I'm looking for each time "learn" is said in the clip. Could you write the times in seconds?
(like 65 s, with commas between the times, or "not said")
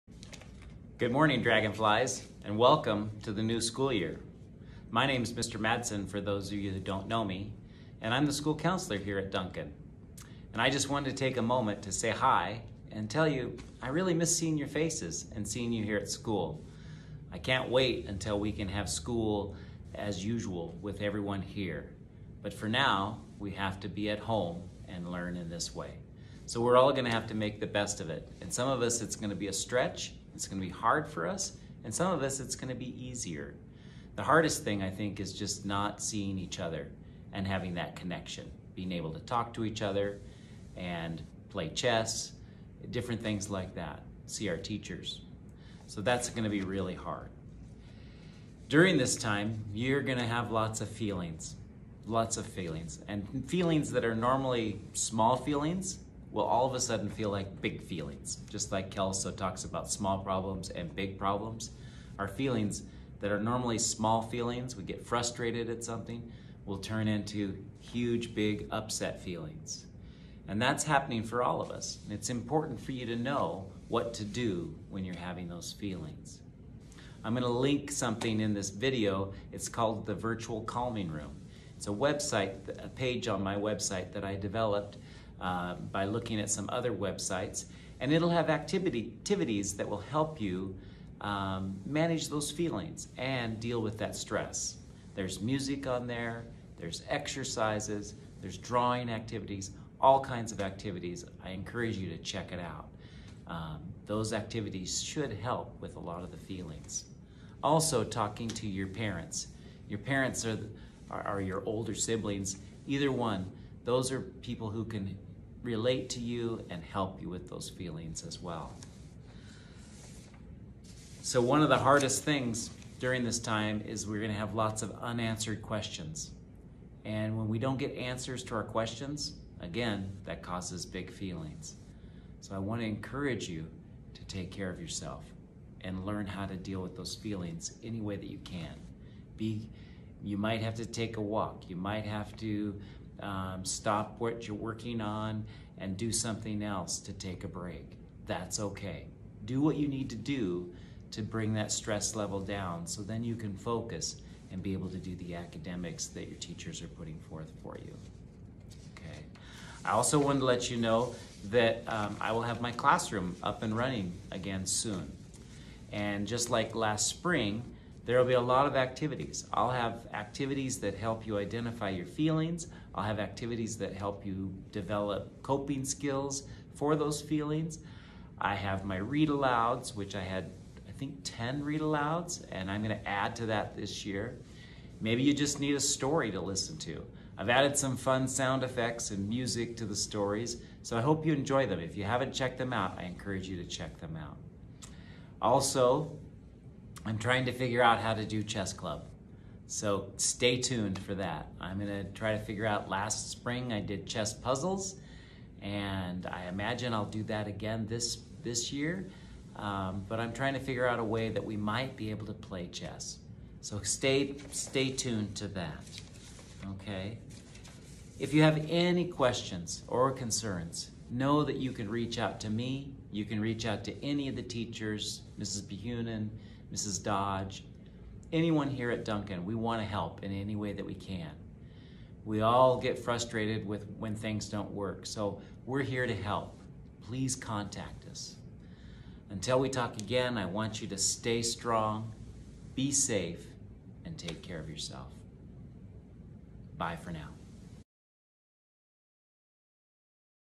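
25 s, 136 s.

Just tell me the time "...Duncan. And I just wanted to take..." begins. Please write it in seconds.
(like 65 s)
9 s.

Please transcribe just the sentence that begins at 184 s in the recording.
Maybe you just need a story to listen to.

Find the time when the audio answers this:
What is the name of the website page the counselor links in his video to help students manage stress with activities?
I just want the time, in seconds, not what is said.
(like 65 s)
80 s.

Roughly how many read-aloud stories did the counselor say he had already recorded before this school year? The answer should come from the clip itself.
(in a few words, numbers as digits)
10.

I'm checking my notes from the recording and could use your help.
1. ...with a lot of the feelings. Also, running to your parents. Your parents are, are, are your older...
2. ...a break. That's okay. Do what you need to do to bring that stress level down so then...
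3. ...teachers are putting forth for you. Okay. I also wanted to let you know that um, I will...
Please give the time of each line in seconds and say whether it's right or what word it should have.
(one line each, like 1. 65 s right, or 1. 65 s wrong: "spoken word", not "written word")
1. 105 s wrong: "talking", not "running"
2. 147 s right
3. 156 s right.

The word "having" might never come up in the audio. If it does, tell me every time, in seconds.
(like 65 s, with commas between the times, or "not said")
37 s, 75 s.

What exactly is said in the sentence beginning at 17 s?
I can't wait until we can have school as usual with everyone here.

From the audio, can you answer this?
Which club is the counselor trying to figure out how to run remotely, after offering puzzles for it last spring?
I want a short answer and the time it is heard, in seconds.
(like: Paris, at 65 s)
chess club, at 198 s.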